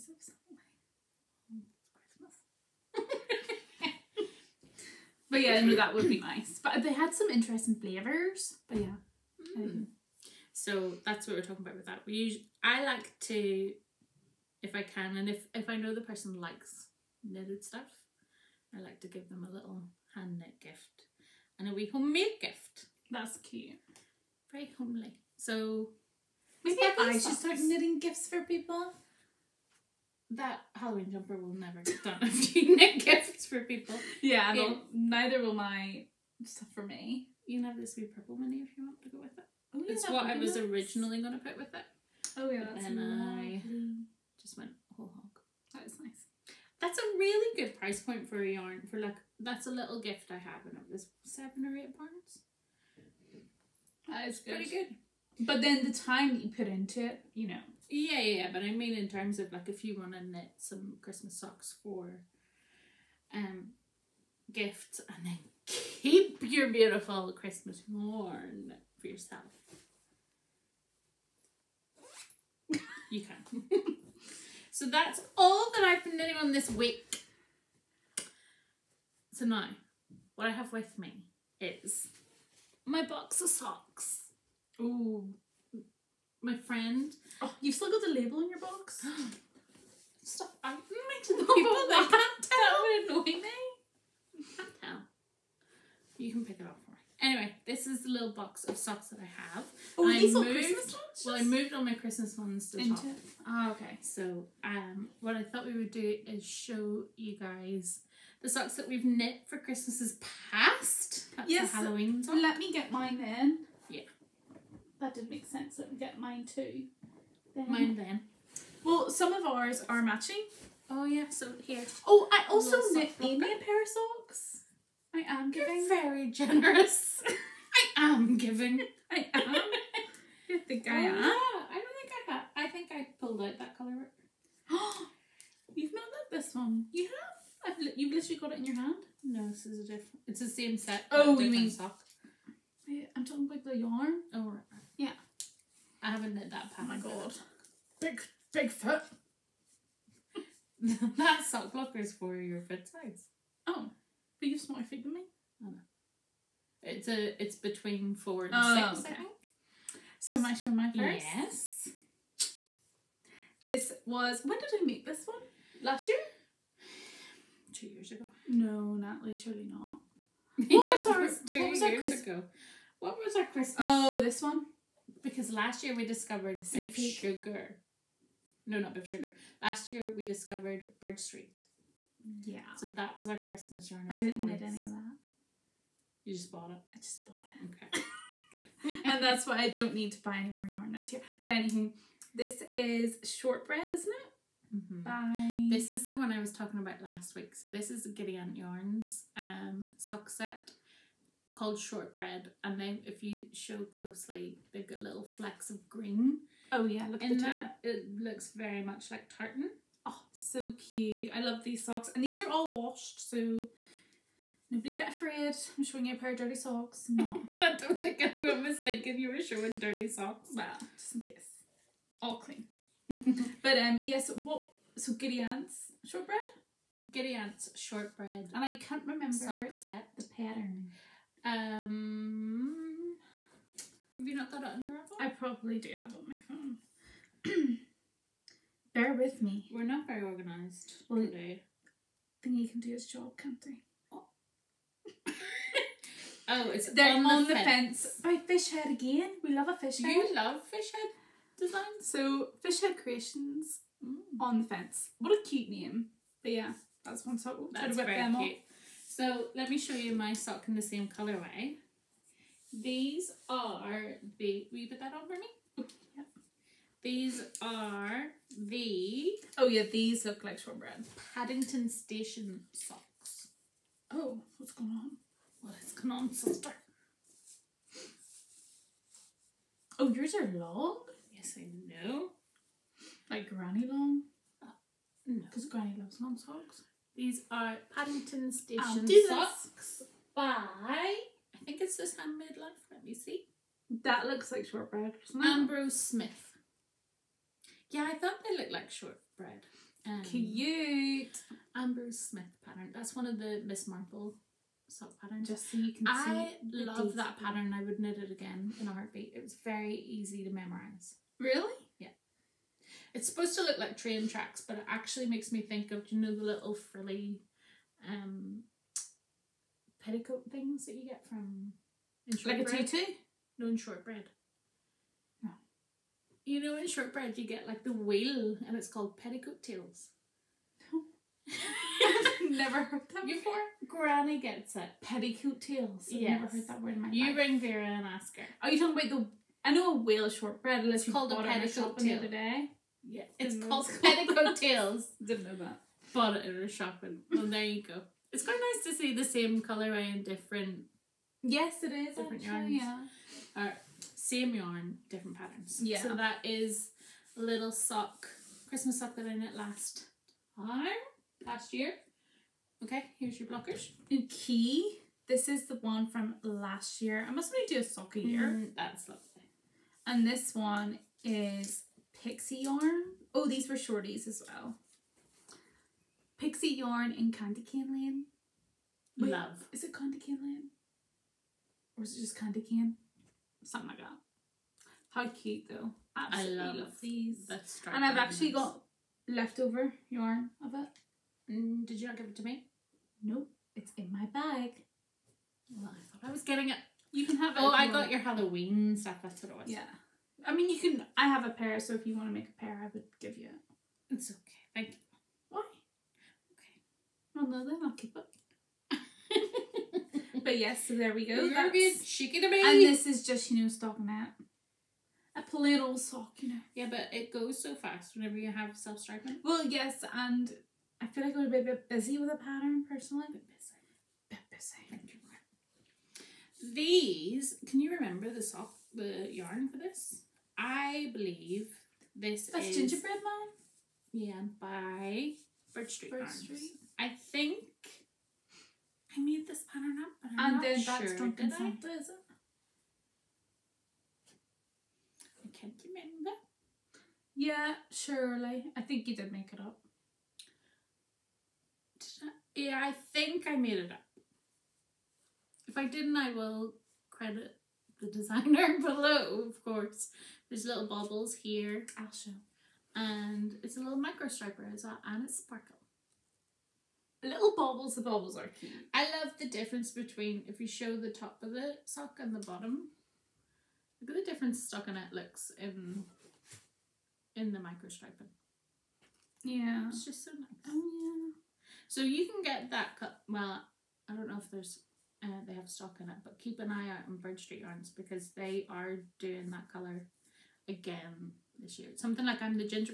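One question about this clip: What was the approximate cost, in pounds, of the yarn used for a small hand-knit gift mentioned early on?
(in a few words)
7 or 8 pounds.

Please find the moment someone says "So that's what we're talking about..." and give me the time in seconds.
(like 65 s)
10 s.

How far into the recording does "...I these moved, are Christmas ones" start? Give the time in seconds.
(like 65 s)
100 s.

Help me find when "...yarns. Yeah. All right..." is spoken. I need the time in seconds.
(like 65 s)
352 s.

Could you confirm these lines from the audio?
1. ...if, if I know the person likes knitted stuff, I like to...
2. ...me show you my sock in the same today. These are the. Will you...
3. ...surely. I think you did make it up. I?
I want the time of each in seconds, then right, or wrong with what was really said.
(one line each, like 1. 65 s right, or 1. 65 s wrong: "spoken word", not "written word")
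1. 15 s right
2. 259 s wrong: "colourway", not "today"
3. 447 s right.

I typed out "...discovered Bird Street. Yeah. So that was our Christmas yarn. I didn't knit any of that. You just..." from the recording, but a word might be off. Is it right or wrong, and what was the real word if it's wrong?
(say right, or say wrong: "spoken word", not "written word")
right.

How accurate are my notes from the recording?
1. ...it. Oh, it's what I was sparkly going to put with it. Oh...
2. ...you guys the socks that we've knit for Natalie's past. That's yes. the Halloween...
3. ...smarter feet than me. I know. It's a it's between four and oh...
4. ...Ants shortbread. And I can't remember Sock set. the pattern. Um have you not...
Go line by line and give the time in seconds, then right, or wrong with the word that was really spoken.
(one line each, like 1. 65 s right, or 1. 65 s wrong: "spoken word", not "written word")
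1. 39 s wrong: "originally", not "sparkly"
2. 107 s wrong: "Christmas", not "Natalie"
3. 154 s right
4. 227 s right.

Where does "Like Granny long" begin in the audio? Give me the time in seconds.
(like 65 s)
283 s.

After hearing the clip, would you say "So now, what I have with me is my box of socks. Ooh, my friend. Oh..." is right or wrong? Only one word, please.
right.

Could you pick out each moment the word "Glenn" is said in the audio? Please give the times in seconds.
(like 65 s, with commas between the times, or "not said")
not said.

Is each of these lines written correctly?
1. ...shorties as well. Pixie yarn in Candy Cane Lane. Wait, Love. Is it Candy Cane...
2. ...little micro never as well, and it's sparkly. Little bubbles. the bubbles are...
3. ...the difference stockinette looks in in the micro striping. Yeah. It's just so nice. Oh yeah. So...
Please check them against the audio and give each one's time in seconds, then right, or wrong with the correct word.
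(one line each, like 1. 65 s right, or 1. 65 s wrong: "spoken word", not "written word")
1. 373 s right
2. 463 s wrong: "striper", not "never"
3. 474 s right.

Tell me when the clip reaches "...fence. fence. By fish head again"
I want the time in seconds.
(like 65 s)
247 s.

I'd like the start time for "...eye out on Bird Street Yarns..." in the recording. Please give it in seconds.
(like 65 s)
486 s.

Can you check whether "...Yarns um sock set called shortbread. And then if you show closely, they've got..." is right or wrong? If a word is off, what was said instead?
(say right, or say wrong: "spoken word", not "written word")
right.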